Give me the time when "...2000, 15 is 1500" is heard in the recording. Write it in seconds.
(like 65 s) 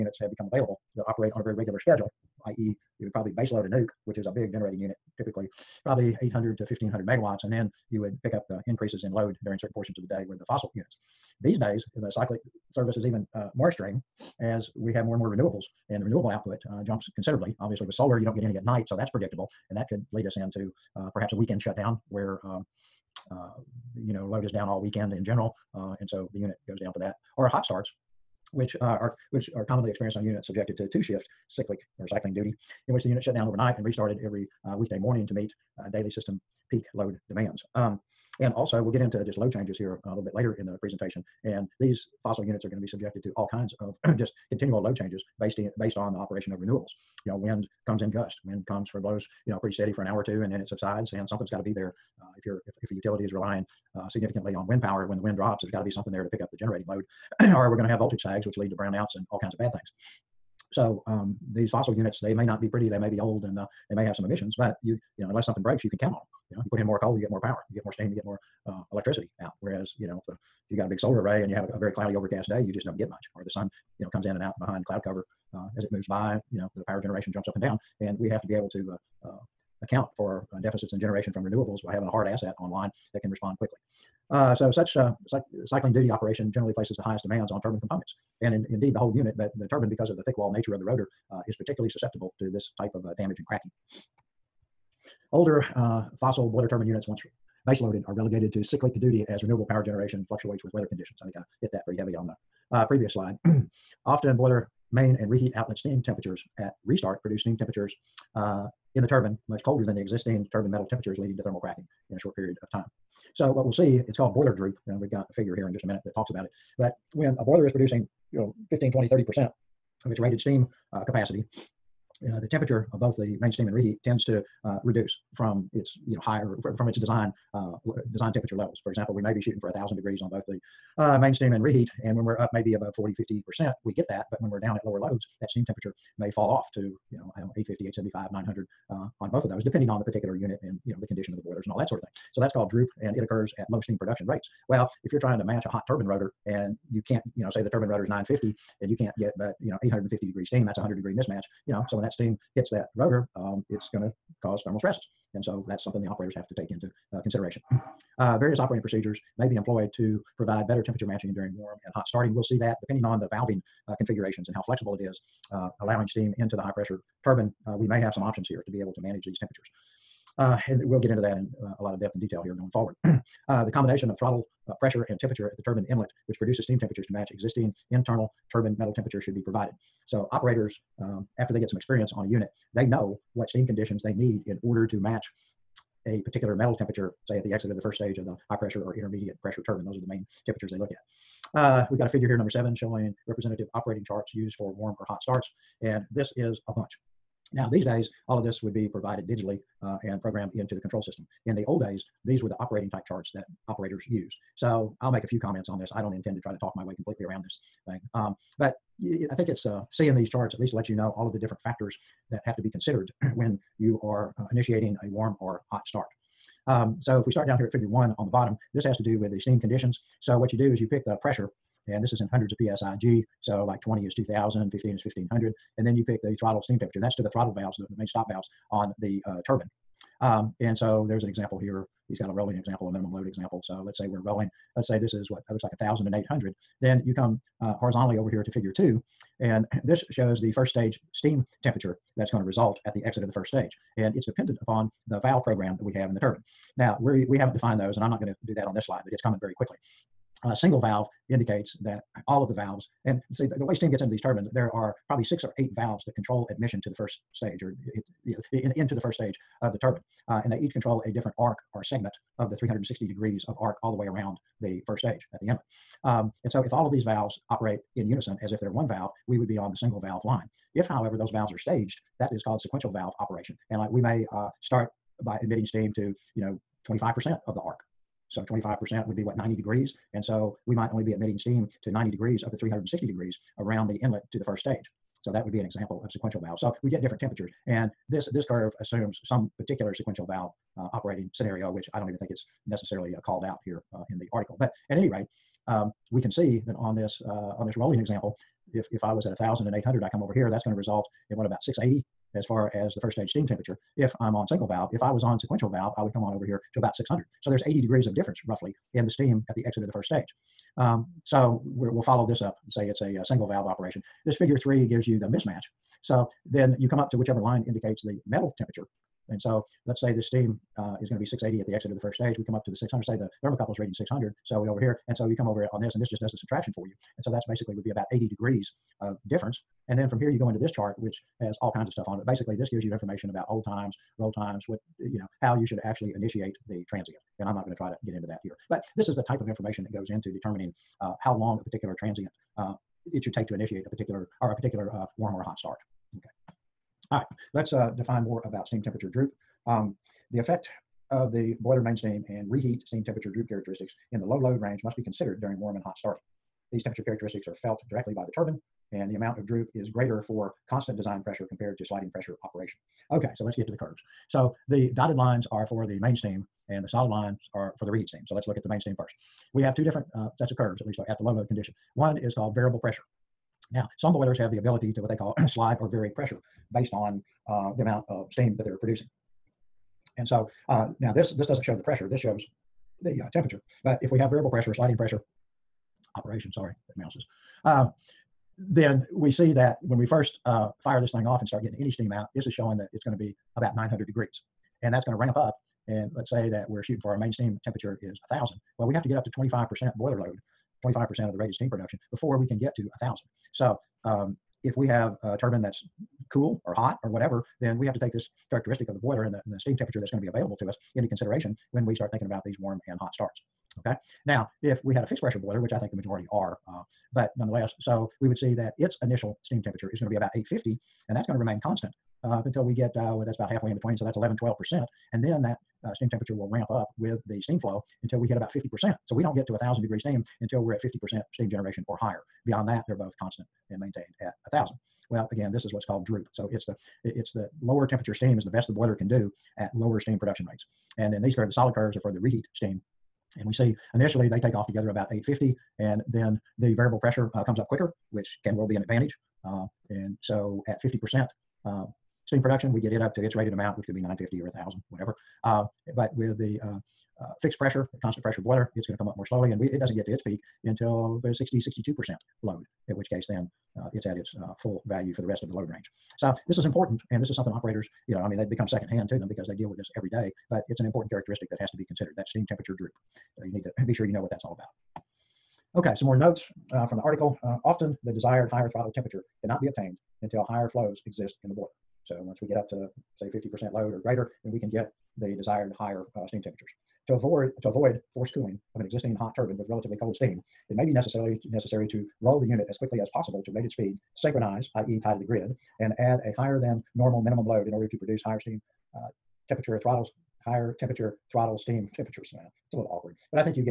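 224 s.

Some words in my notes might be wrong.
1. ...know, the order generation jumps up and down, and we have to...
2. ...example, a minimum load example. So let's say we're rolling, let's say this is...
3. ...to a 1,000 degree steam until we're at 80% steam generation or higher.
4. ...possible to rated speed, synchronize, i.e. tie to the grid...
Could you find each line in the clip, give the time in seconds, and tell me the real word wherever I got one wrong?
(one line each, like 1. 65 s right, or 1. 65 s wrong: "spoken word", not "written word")
1. 76 s wrong: "power", not "order"
2. 232 s right
3. 429 s wrong: "50", not "80"
4. 493 s right.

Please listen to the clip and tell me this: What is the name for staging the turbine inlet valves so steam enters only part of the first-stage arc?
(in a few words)
sequential valve operation.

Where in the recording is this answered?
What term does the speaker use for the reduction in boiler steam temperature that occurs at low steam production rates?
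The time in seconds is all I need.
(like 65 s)
114 s.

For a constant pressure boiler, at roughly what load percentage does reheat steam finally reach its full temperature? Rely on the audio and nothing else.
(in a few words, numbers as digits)
60 to 62 percent.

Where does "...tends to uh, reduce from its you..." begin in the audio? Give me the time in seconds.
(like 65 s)
124 s.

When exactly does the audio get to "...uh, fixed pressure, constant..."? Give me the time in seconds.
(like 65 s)
457 s.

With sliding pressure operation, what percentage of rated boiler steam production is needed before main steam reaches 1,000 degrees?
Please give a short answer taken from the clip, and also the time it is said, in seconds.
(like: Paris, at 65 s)
25%, at 399 s.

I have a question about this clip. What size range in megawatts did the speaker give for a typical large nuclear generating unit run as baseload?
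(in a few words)
800 to 1500 megawatts.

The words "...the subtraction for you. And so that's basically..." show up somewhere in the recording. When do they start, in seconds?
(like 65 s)
326 s.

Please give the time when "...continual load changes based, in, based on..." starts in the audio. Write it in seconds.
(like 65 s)
44 s.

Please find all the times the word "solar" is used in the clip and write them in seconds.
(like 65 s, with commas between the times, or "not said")
17 s, 70 s.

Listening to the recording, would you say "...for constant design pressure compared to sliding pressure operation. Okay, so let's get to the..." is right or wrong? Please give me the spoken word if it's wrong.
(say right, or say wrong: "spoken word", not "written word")
right.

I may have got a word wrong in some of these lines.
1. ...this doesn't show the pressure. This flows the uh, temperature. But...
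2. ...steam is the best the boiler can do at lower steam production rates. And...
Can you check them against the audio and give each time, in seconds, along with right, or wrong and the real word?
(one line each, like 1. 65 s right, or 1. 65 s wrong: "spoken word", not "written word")
1. 381 s wrong: "shows", not "flows"
2. 438 s right.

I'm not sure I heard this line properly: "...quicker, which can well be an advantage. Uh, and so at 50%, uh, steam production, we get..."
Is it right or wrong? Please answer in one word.
right.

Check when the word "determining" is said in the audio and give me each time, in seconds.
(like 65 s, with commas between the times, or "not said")
340 s.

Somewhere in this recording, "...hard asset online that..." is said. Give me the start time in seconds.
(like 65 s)
82 s.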